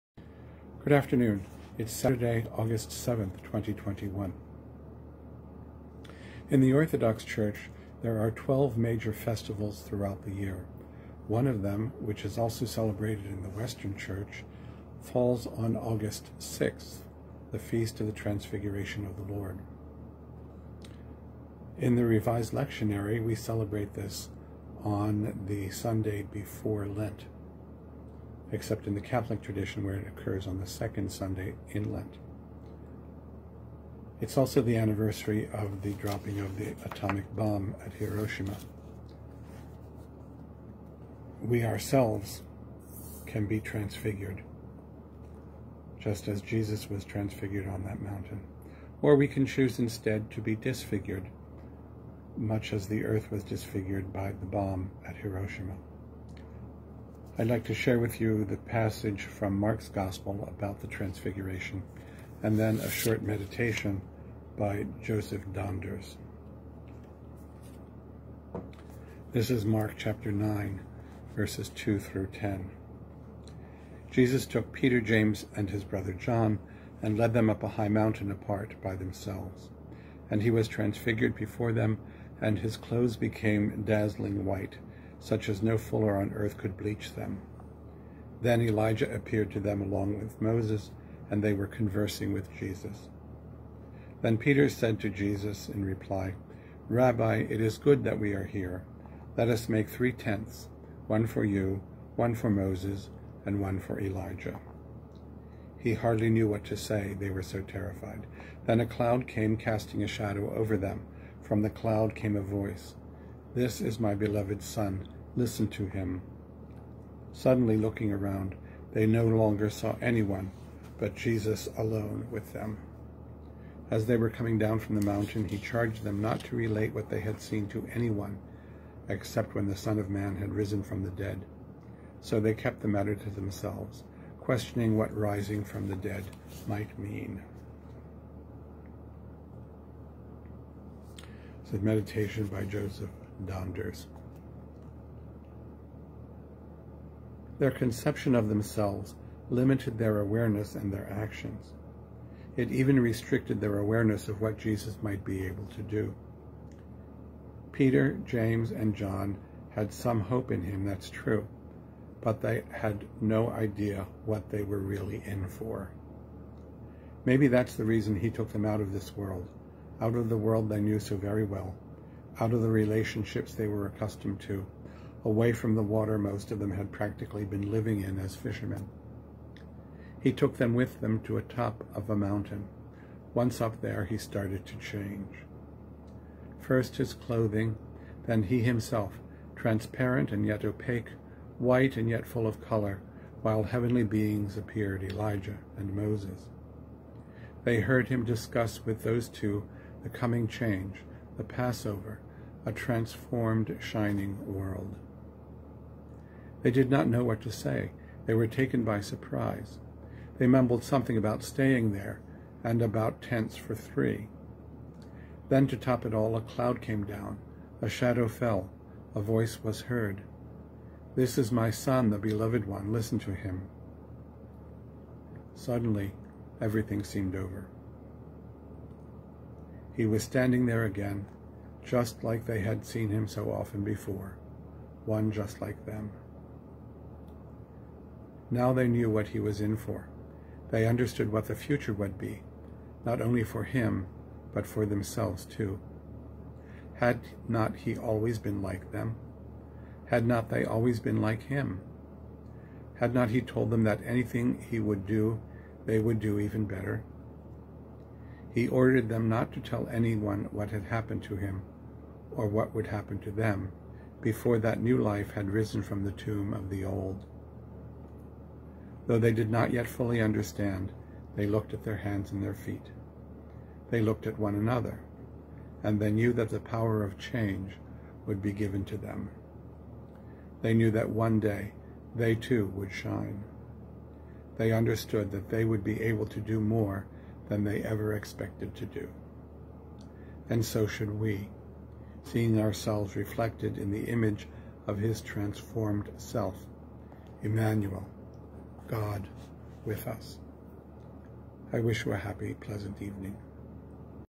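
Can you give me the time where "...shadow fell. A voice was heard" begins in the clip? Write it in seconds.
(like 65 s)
217 s.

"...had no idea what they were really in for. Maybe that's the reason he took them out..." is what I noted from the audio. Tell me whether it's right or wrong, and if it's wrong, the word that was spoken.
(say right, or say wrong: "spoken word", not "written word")
right.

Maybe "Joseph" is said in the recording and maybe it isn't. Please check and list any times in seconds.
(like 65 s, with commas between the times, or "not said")
65 s, 142 s.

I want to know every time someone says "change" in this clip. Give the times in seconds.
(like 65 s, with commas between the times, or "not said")
184 s, 200 s, 277 s.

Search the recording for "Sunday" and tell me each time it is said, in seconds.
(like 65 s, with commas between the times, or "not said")
25 s, 31 s.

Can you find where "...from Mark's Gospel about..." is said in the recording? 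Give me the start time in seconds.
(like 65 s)
59 s.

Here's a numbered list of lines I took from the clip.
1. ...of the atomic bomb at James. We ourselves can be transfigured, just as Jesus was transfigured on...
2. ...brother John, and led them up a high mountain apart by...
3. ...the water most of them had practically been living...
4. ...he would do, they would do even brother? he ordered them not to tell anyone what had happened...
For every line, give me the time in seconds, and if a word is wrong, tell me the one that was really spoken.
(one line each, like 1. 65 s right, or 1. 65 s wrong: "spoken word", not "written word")
1. 36 s wrong: "Hiroshima", not "James"
2. 75 s right
3. 175 s right
4. 254 s wrong: "better", not "brother".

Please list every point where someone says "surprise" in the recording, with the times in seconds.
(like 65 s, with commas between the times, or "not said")
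209 s.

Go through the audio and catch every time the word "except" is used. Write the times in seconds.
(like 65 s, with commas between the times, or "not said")
28 s, 129 s.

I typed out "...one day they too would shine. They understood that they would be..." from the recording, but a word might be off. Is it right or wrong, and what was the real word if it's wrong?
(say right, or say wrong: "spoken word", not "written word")
right.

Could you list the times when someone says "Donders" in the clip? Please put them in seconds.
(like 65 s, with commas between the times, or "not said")
65 s, 143 s.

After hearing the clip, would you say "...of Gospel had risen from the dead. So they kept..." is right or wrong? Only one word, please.
wrong.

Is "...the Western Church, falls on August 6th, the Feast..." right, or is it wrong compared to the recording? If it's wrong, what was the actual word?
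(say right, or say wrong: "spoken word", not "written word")
right.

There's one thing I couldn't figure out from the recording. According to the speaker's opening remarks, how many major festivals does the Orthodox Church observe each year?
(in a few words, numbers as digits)
12.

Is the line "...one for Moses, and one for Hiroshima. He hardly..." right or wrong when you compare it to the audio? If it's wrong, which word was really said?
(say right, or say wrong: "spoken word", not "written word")
wrong: "Elijah", not "Hiroshima".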